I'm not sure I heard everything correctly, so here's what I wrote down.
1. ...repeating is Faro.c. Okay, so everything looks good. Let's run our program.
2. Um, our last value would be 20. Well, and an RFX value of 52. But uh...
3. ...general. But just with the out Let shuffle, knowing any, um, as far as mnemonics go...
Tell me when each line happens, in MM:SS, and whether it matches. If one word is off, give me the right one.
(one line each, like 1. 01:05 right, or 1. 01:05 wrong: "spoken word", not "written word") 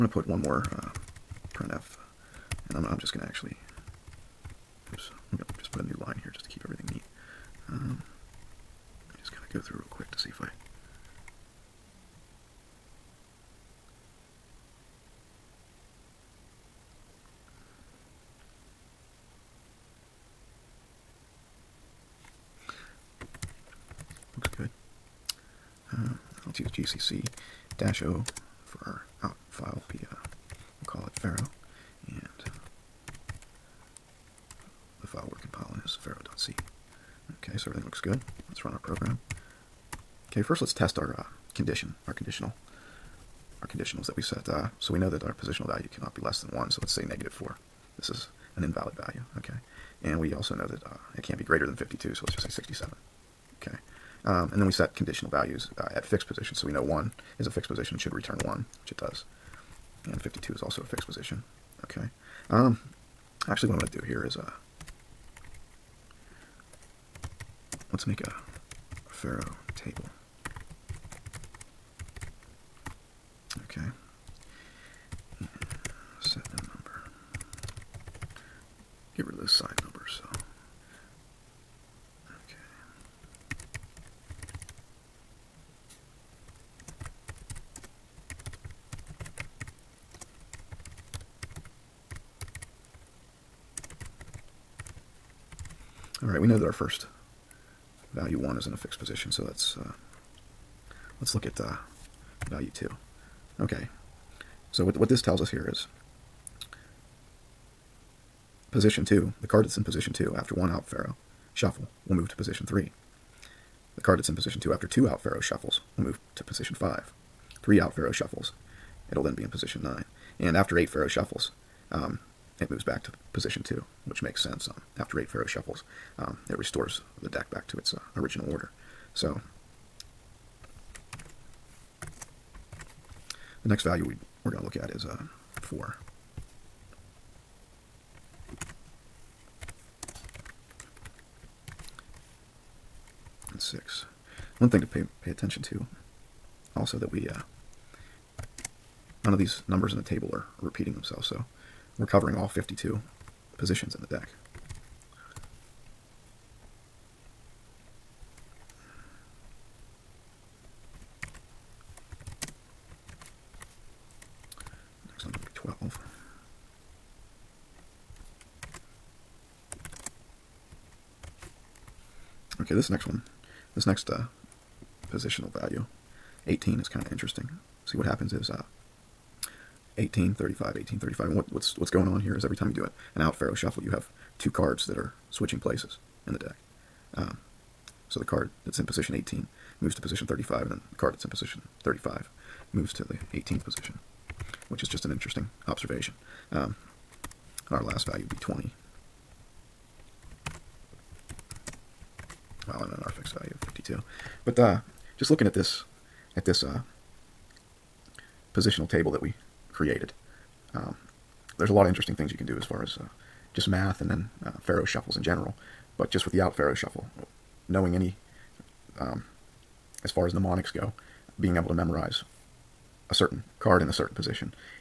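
1. 00:35 wrong: "compiling", not "repeating"
2. 03:16 right
3. 03:35 wrong: "Faro", not "Let".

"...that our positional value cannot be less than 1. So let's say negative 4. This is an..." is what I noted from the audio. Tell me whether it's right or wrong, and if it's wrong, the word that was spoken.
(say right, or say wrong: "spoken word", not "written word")
right.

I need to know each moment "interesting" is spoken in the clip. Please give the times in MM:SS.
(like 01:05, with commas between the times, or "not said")
02:57, 03:15, 03:31.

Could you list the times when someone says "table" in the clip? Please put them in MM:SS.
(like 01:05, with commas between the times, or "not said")
01:09, 02:30, 03:28.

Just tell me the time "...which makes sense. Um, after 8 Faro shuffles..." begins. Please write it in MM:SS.
02:04.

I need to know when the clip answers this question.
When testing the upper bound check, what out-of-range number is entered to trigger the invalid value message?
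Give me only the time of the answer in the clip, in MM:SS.
00:52.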